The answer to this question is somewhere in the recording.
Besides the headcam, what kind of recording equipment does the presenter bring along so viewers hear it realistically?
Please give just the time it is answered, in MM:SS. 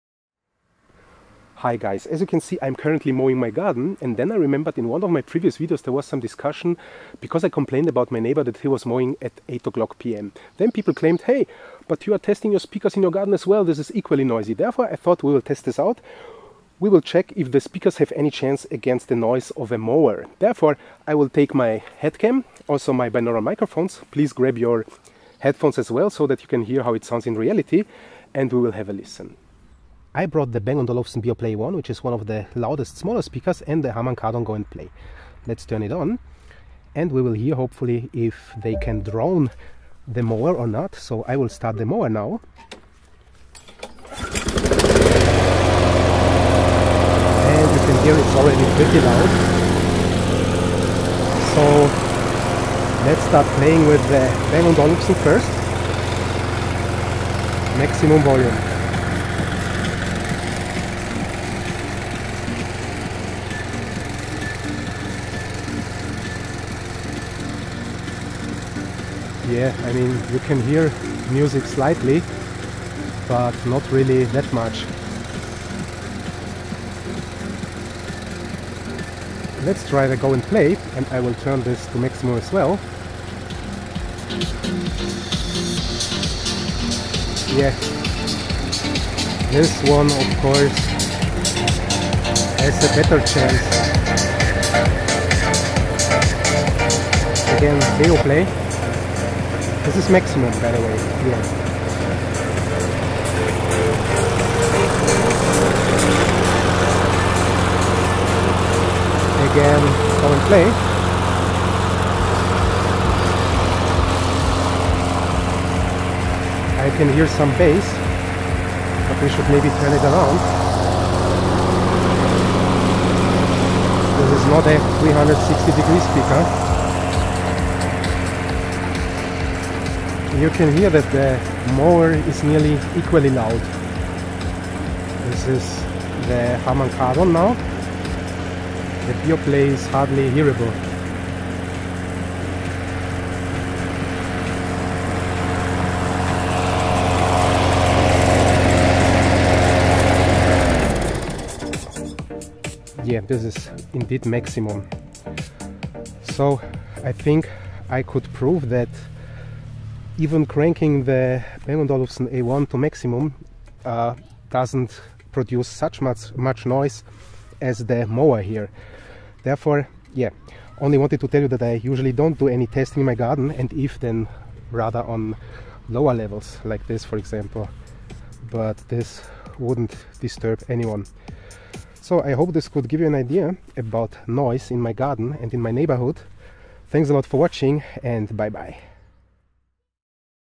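00:23.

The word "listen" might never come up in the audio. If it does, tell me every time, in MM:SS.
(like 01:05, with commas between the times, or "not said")
00:28.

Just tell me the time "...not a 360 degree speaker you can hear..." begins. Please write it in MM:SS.
02:04.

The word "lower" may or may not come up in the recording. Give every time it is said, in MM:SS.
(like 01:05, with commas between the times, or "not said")
02:55.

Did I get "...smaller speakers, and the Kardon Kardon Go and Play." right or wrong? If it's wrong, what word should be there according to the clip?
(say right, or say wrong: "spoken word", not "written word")
wrong: "Harman", not "Kardon".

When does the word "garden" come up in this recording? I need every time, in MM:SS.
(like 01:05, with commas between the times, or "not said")
00:03, 00:13, 02:53, 03:04.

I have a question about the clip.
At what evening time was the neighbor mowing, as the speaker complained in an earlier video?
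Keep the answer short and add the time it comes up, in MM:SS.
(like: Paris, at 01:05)
8 pm, at 00:09.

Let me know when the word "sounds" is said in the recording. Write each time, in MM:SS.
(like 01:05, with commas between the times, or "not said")
00:27.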